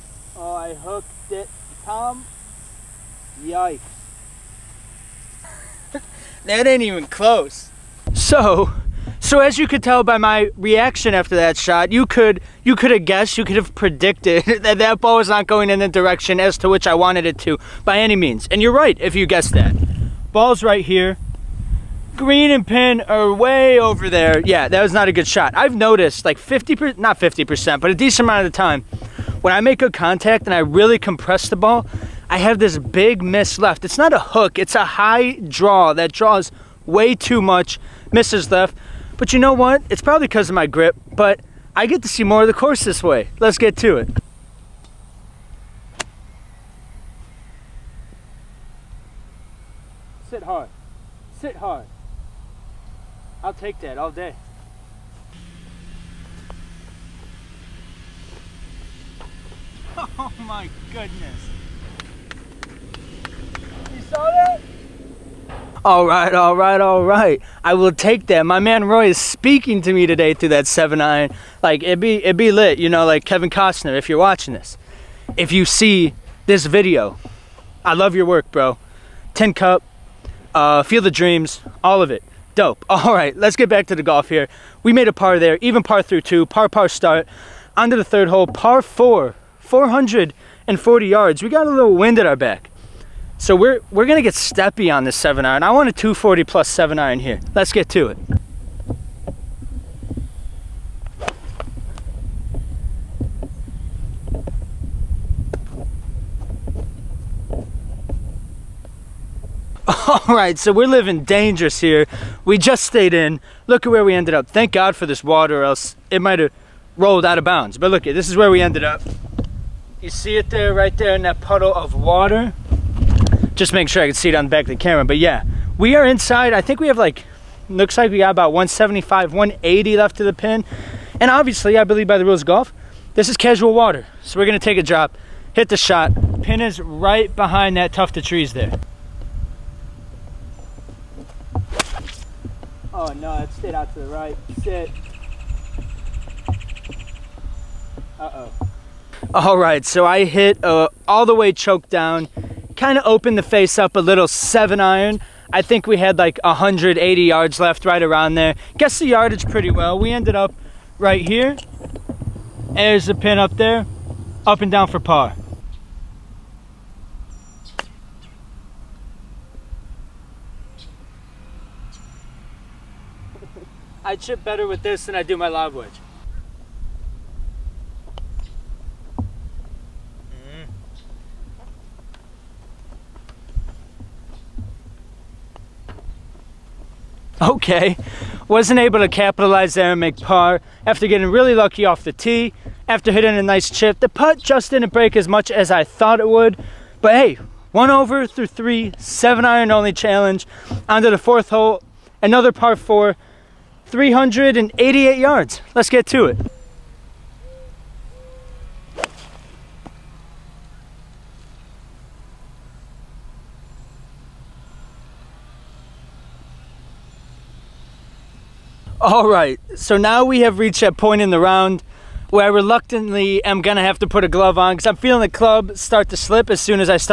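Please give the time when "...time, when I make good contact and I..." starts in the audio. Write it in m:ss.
0:28.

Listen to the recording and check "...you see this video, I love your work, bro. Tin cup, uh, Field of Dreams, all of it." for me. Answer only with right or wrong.
right.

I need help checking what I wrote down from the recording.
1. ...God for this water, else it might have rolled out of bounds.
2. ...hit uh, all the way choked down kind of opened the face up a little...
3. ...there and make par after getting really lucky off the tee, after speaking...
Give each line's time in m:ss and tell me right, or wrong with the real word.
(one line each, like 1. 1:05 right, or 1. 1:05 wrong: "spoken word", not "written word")
1. 1:54 right
2. 2:30 right
3. 3:09 wrong: "hitting", not "speaking".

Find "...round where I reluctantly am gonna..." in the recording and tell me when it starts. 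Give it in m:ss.
3:41.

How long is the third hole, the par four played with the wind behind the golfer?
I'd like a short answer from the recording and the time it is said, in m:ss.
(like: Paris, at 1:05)
440 yards, at 1:29.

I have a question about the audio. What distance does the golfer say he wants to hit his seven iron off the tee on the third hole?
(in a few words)
240 plus.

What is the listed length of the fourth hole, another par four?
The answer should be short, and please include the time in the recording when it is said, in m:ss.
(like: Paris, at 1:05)
388 yards, at 3:23.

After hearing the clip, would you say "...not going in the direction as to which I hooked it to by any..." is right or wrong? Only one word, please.
wrong.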